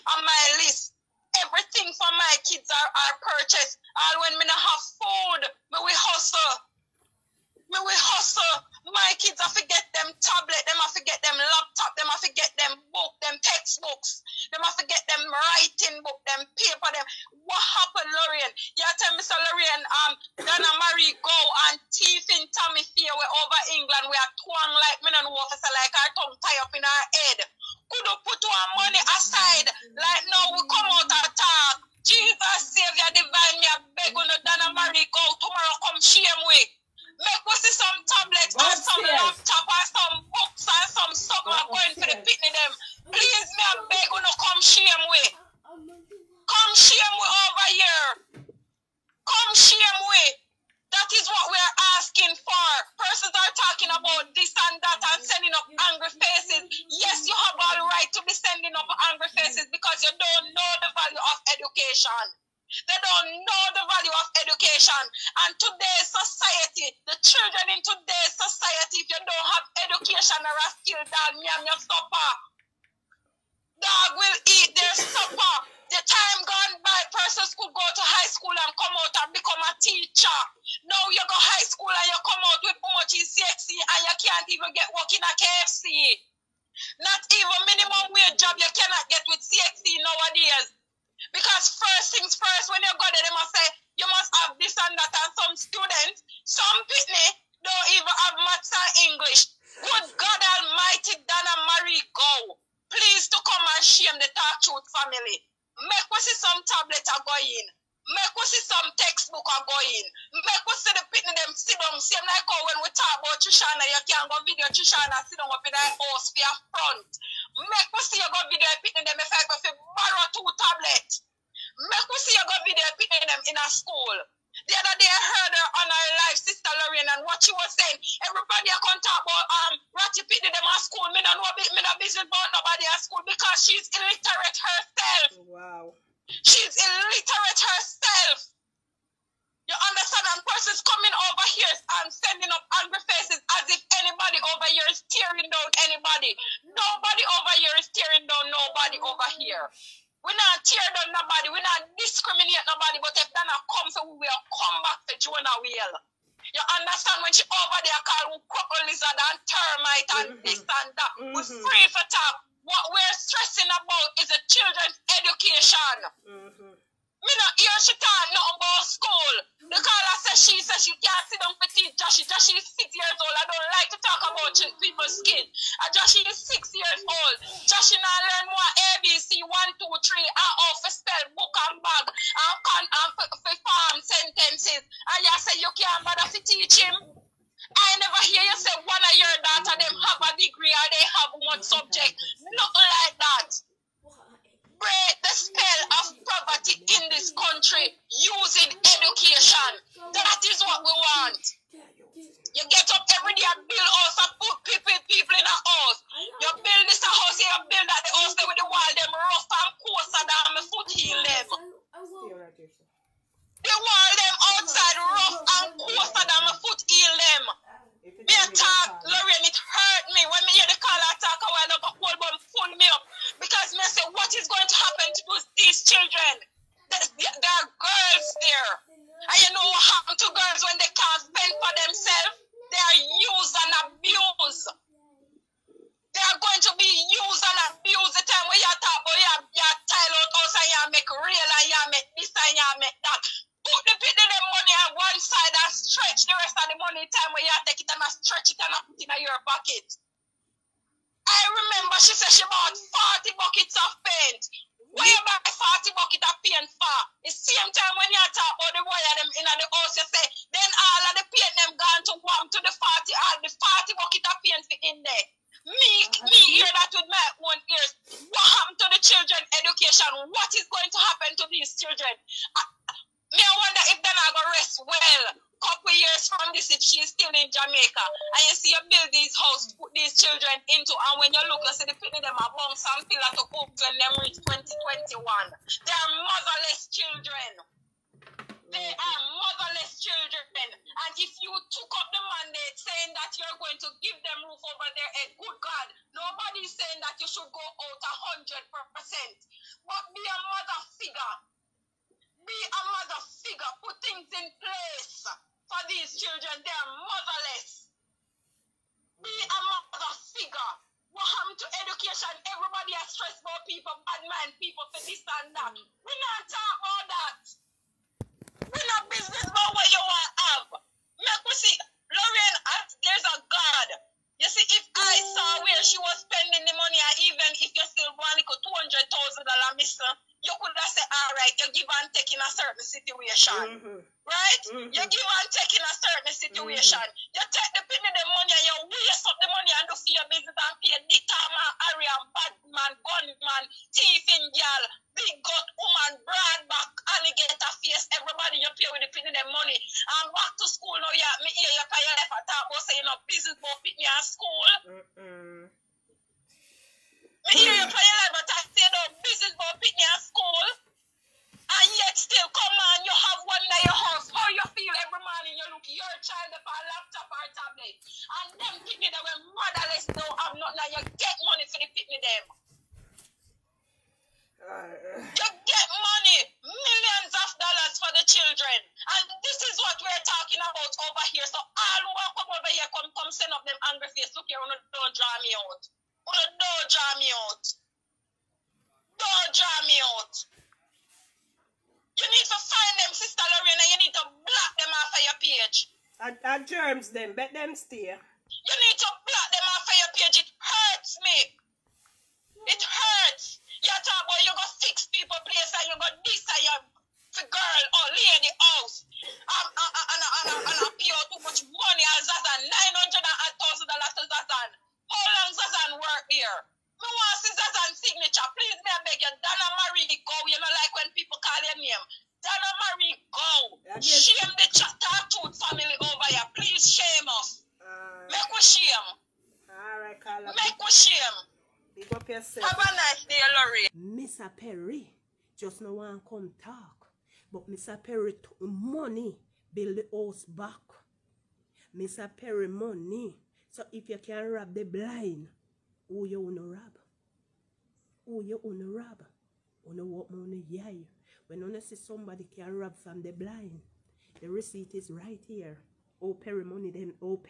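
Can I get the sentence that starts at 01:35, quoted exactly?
And some students, some people don't even have maths and English.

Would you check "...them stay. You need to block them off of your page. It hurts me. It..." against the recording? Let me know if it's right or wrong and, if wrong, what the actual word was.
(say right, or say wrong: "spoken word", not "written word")
right.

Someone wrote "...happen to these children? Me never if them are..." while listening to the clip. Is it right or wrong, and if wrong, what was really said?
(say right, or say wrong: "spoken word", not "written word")
wrong: "wonder", not "never".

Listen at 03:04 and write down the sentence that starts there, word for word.
And you say you can't bother to teach him.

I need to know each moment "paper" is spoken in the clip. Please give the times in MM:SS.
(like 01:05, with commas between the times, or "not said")
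00:16.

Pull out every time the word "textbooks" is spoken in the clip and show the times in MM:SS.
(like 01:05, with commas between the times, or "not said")
00:13, 01:48.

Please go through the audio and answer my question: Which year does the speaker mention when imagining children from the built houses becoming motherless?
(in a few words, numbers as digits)
2021.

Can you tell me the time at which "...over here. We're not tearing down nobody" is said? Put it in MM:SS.
02:29.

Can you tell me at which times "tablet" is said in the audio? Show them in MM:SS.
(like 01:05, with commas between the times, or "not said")
00:10, 00:38, 01:46, 02:00, 06:07.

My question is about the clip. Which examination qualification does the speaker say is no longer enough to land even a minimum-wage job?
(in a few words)
CXC.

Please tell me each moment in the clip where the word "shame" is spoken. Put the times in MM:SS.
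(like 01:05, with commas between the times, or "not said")
00:36, 00:44, 01:43.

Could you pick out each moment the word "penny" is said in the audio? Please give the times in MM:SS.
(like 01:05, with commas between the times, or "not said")
05:37, 05:49.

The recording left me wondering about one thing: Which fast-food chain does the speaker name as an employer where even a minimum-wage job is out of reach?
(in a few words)
KFC.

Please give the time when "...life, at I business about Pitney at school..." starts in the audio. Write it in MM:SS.
05:58.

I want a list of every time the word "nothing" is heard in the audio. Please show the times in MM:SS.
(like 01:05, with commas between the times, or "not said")
02:48, 03:12.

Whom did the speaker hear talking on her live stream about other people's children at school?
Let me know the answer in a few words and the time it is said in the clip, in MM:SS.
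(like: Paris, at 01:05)
Sister Lorraine, at 02:06.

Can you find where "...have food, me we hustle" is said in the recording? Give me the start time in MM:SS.
00:04.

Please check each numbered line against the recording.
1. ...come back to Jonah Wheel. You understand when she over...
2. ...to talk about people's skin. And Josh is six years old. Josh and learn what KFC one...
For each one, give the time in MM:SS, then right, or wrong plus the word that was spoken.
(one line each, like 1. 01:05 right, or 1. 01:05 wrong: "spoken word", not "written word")
1. 02:34 right
2. 02:53 wrong: "ABC", not "KFC".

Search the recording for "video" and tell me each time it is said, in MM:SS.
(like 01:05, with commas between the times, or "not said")
01:54, 01:58, 02:02.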